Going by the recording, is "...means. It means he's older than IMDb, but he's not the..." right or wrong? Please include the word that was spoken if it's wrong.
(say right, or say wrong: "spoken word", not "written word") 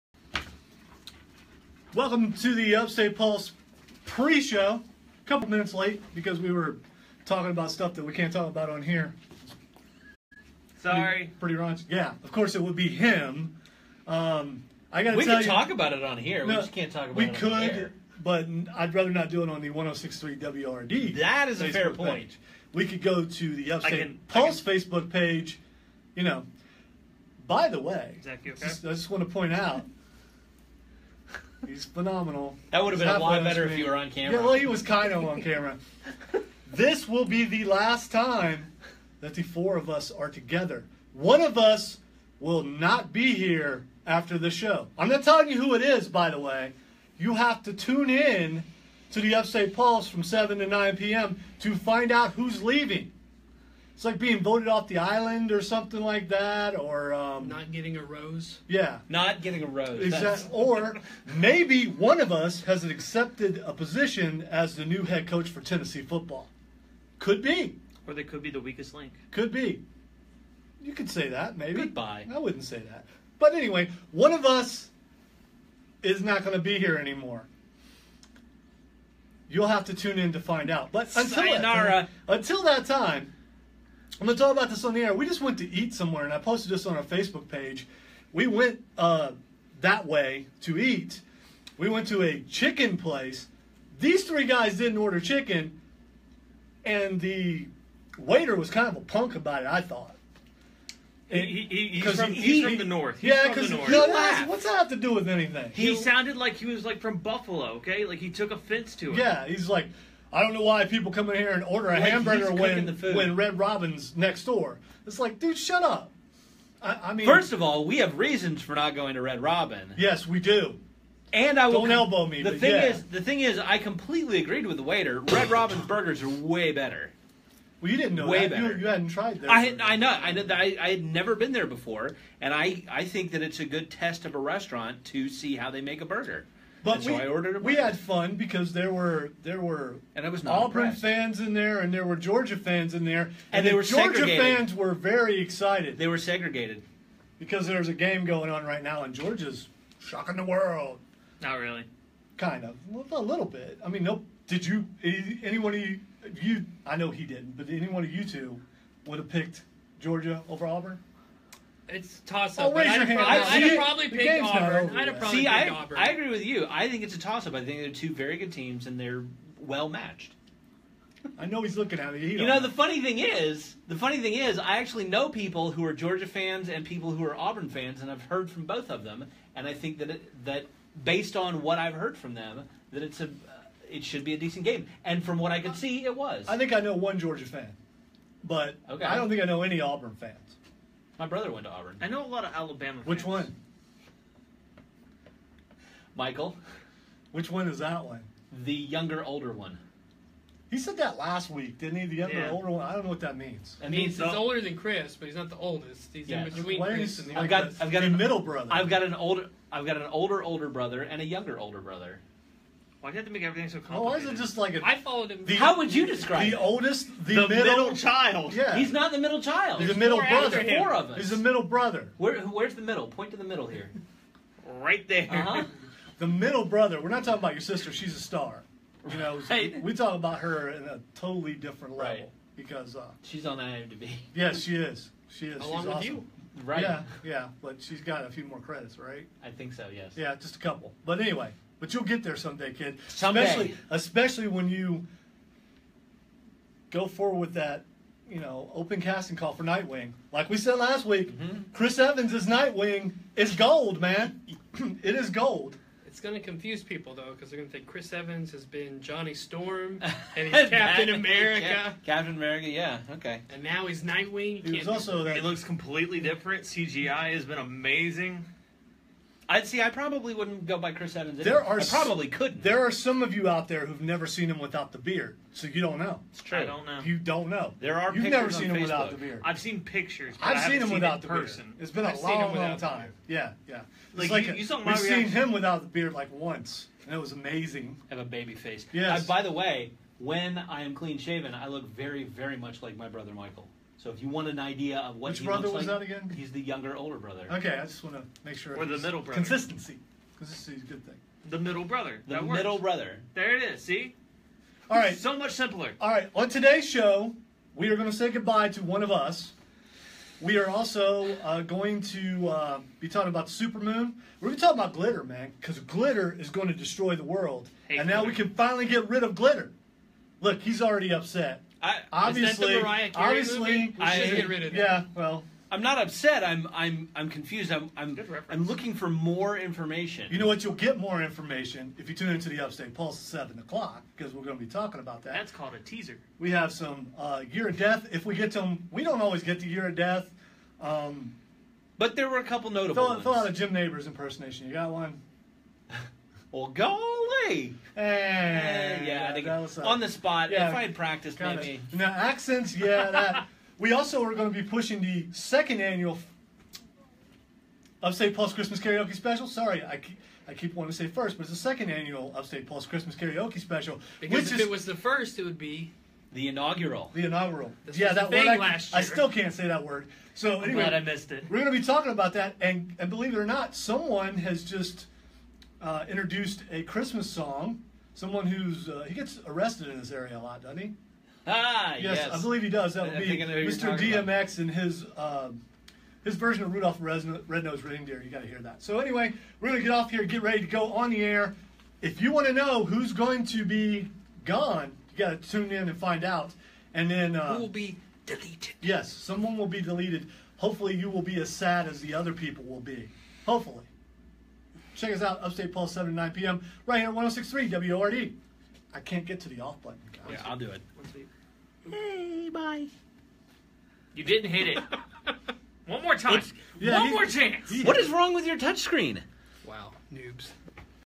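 wrong: "Chris", not "IMDb".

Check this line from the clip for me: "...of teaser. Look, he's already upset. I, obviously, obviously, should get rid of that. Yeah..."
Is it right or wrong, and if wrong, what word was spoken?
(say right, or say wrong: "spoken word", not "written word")
wrong: "glitter", not "teaser".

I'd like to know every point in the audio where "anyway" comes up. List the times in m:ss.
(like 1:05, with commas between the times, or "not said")
1:13, 4:01, 6:10, 6:28.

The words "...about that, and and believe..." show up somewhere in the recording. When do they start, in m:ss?
6:12.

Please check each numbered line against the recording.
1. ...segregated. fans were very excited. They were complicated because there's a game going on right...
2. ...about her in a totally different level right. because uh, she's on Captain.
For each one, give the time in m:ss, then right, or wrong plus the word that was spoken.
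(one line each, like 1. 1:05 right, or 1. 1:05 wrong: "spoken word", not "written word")
1. 2:24 wrong: "segregated", not "complicated"
2. 3:50 wrong: "IMDb", not "Captain".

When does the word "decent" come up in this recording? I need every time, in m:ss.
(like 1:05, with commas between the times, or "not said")
3:04.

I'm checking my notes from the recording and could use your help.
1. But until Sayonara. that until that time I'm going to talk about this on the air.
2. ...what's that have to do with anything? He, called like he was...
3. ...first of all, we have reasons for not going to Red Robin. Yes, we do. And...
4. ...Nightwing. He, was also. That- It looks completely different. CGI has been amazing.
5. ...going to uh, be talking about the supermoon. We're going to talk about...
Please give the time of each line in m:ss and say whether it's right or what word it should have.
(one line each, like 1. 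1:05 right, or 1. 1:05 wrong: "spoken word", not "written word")
1. 1:20 right
2. 1:43 wrong: "sounded", not "called"
3. 1:57 right
4. 4:24 right
5. 5:11 right.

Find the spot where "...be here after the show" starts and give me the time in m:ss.
0:43.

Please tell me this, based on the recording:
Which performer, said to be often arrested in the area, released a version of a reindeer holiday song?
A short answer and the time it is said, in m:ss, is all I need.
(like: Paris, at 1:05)
DMX, at 6:23.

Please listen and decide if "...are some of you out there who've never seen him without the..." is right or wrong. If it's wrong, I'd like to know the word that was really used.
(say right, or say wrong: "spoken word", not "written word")
right.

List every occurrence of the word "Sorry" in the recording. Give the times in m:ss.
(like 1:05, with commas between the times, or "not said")
0:10, 5:59.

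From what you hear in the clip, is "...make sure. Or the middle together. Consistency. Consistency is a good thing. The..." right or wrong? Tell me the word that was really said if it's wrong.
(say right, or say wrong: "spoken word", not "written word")
wrong: "brother", not "together".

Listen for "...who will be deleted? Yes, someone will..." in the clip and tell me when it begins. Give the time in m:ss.
6:37.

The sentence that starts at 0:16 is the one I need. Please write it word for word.
No, we just can't talk about we it.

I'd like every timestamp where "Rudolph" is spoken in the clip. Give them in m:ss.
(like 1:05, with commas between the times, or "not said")
6:26.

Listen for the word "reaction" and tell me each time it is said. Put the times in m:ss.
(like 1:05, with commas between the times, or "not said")
4:45.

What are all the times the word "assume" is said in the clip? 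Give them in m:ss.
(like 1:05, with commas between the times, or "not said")
not said.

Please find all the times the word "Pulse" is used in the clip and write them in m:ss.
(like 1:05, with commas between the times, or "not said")
0:03, 0:24, 0:49, 5:32, 5:58, 6:02, 6:45.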